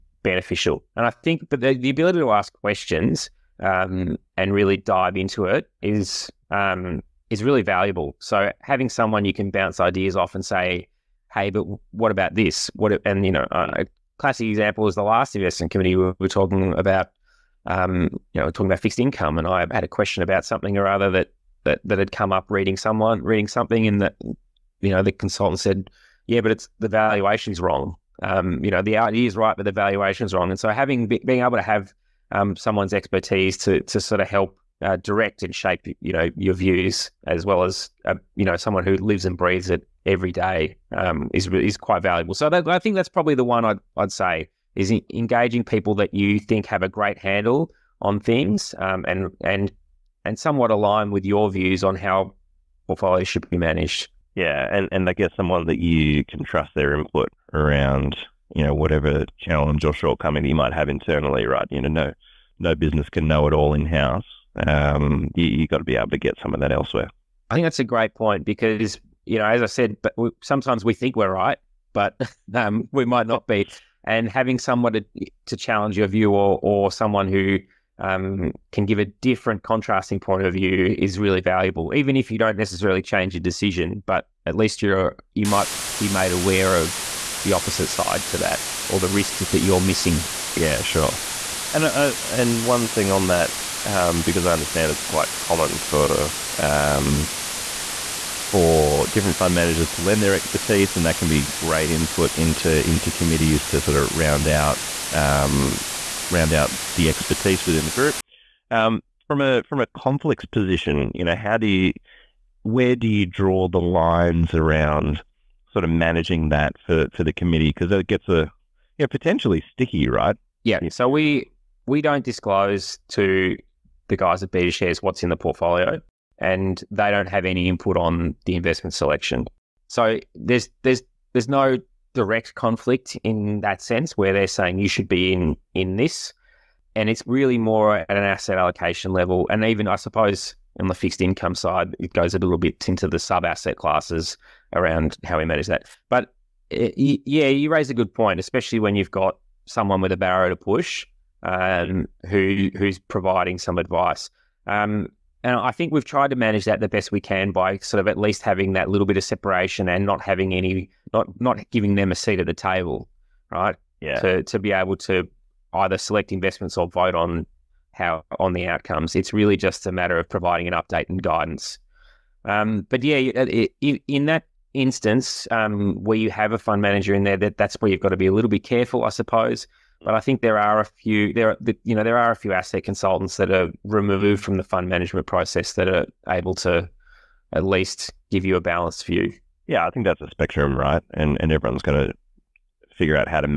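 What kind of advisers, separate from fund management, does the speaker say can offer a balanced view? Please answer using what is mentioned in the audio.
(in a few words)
Asset consultants.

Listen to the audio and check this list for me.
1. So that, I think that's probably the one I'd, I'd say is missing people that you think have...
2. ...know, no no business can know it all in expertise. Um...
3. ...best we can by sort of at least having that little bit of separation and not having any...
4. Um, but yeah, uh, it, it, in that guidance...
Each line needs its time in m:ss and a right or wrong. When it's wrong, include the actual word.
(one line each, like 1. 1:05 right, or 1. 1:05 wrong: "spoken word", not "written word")
1. 0:42 wrong: "engaging", not "missing"
2. 1:01 wrong: "house", not "expertise"
3. 2:36 right
4. 2:52 wrong: "instance", not "guidance".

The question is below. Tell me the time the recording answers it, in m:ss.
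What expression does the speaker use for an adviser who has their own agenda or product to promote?
2:30.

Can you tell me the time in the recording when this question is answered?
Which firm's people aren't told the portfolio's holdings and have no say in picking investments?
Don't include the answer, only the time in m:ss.
2:04.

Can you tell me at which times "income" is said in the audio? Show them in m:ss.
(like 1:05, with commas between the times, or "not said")
0:18, 2:21.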